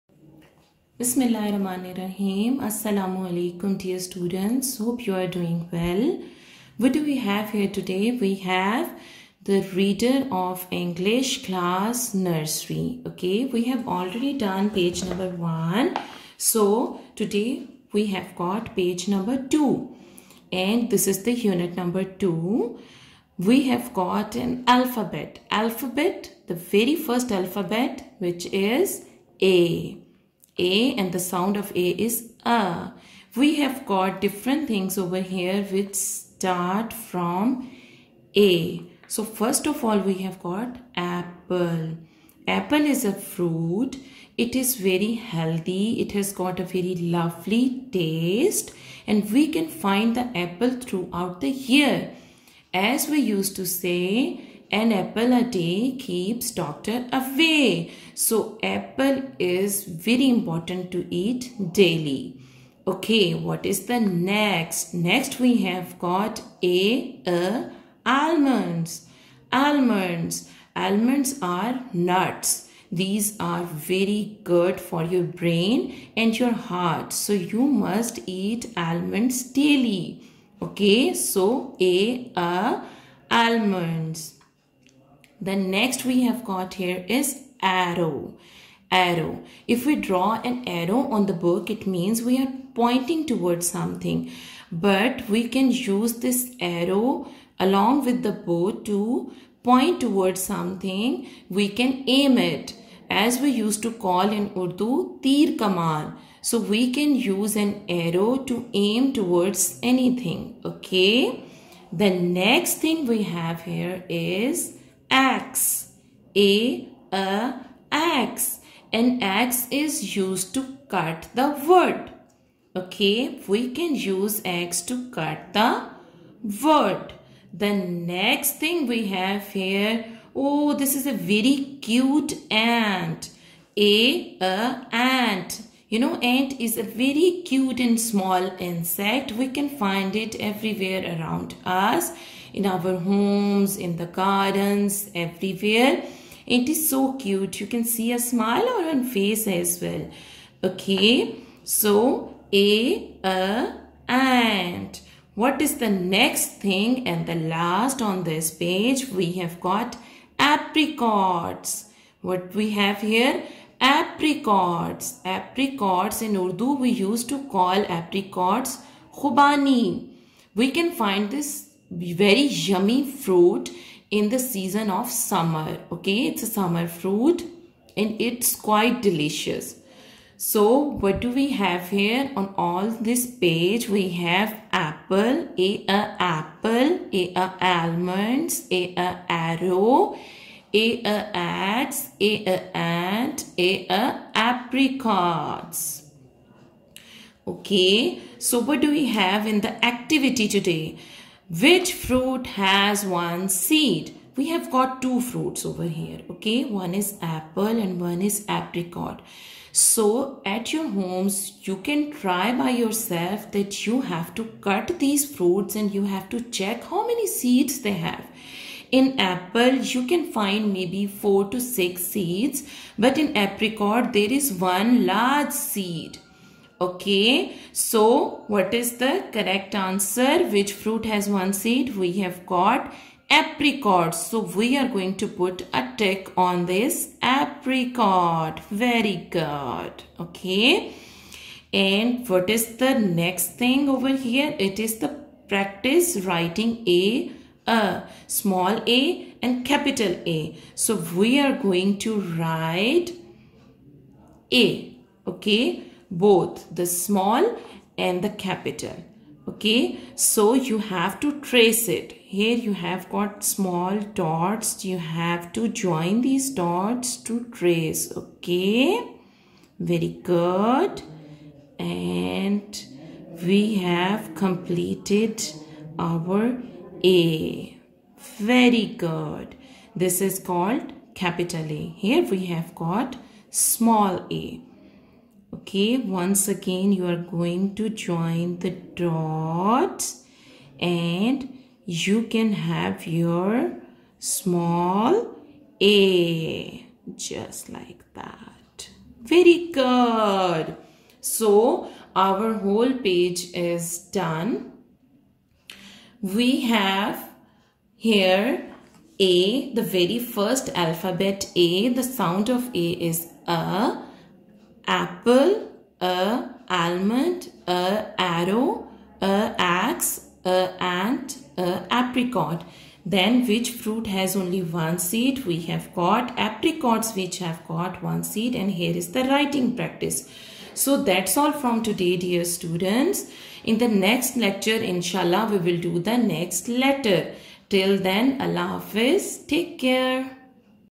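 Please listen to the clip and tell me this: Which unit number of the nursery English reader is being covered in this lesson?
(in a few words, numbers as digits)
2.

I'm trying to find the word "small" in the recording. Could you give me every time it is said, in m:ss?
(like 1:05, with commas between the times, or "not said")
2:17, 4:08, 4:16, 4:23, 4:43, 4:54.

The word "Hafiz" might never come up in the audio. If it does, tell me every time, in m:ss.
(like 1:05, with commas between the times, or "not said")
5:38.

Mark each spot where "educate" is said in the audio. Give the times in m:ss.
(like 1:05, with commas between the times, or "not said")
not said.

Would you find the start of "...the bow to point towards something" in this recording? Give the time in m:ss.
1:38.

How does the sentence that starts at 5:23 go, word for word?
Then which fruit has only one seed?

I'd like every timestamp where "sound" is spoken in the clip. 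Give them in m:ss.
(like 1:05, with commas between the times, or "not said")
0:31, 5:12.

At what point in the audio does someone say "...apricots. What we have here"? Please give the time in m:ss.
2:40.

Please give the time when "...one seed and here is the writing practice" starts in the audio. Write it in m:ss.
5:28.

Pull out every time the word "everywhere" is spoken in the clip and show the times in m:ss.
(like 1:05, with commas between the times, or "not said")
2:20, 2:25.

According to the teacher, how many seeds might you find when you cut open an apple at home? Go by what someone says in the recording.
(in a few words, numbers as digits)
4 to 6.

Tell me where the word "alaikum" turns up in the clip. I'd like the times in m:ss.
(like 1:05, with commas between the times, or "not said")
0:03.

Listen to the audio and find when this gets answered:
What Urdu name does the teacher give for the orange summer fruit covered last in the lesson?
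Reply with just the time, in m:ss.
2:49.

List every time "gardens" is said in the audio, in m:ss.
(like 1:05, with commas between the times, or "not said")
2:24.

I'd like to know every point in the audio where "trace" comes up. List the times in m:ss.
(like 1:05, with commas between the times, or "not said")
4:21, 4:27.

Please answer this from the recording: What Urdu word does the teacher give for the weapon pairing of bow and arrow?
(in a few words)
tir kamal.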